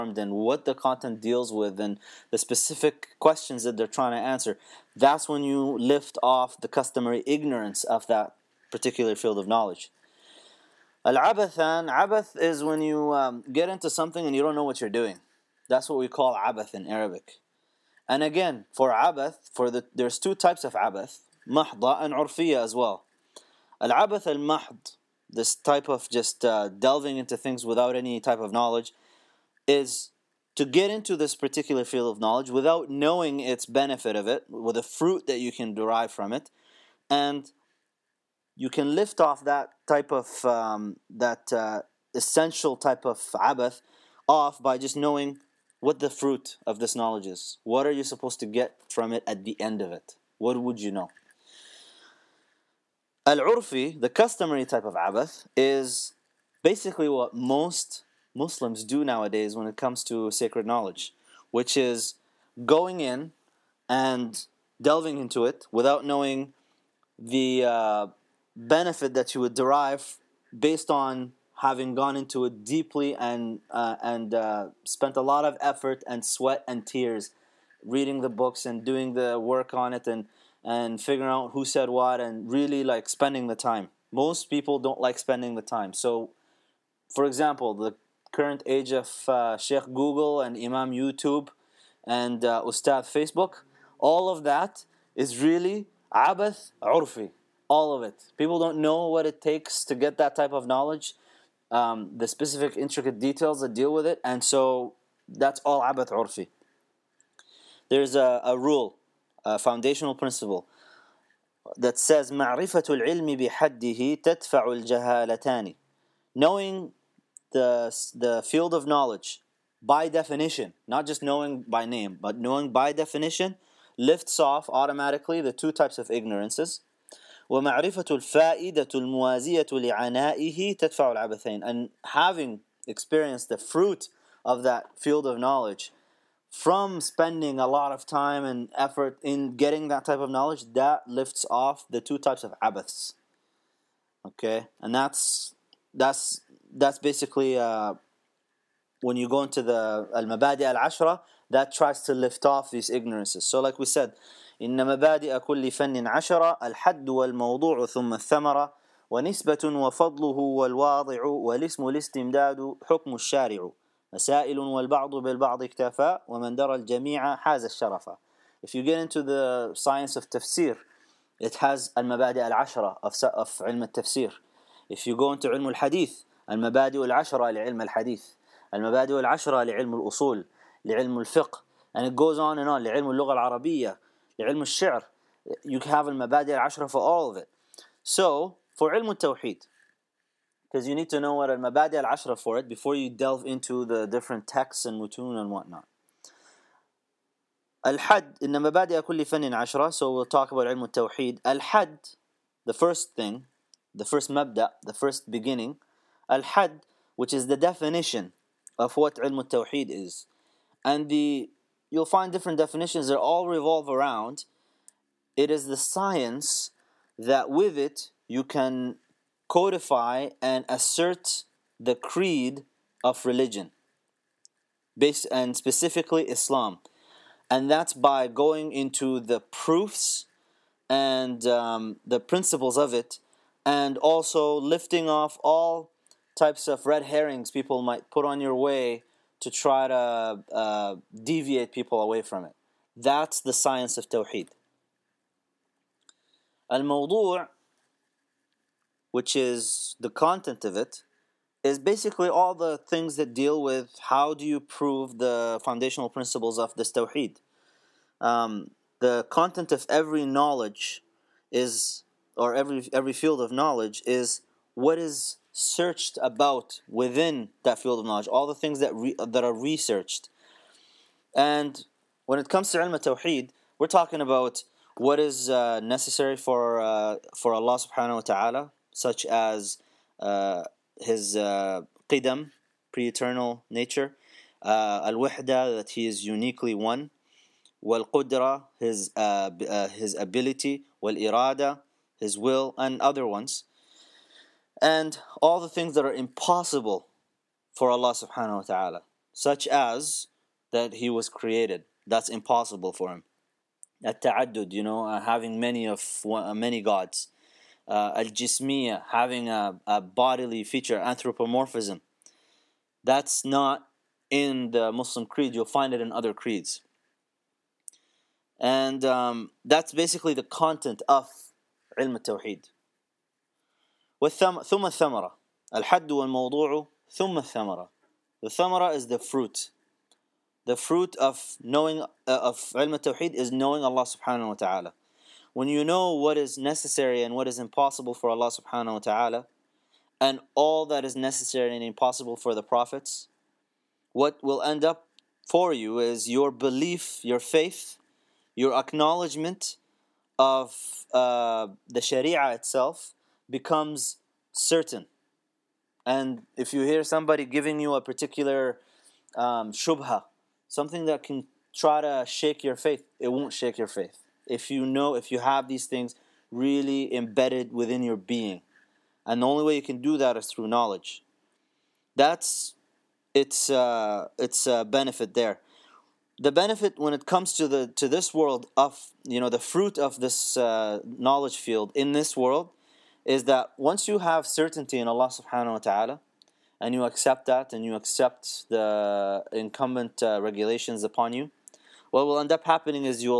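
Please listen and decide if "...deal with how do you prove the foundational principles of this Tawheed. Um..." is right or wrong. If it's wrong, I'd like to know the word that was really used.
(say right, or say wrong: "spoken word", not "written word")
right.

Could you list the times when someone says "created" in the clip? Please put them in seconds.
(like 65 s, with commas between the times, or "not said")
301 s.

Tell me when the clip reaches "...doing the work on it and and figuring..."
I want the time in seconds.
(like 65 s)
78 s.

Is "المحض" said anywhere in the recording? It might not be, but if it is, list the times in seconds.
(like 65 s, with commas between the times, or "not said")
24 s.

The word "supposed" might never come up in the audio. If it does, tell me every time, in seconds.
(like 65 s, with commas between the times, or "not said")
48 s.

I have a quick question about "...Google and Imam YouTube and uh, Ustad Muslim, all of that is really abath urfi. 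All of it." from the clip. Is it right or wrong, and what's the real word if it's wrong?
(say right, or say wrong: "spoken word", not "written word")
wrong: "Facebook", not "Muslim".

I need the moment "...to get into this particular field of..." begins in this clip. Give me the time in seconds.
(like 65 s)
30 s.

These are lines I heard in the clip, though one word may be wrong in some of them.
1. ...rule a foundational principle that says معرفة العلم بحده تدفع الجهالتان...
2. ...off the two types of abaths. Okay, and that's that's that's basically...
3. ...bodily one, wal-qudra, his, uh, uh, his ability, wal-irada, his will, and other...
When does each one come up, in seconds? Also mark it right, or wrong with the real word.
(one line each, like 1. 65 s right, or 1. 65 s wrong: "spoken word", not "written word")
1. 108 s right
2. 141 s right
3. 286 s wrong: "uniquely", not "bodily".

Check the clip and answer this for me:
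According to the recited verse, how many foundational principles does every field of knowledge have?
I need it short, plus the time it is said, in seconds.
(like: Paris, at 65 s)
10, at 156 s.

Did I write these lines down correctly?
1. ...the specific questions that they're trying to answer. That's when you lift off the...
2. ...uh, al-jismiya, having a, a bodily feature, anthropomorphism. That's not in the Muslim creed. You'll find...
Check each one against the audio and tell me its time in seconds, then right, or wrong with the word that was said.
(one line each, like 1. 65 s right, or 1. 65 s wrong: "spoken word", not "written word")
1. 2 s right
2. 307 s right.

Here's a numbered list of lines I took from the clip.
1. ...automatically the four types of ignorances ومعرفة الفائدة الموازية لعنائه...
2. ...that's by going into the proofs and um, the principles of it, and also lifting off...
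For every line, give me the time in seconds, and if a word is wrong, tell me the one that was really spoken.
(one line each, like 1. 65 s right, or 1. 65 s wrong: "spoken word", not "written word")
1. 124 s wrong: "two", not "four"
2. 227 s right.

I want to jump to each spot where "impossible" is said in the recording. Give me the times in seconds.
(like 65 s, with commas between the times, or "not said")
296 s, 302 s, 337 s, 341 s.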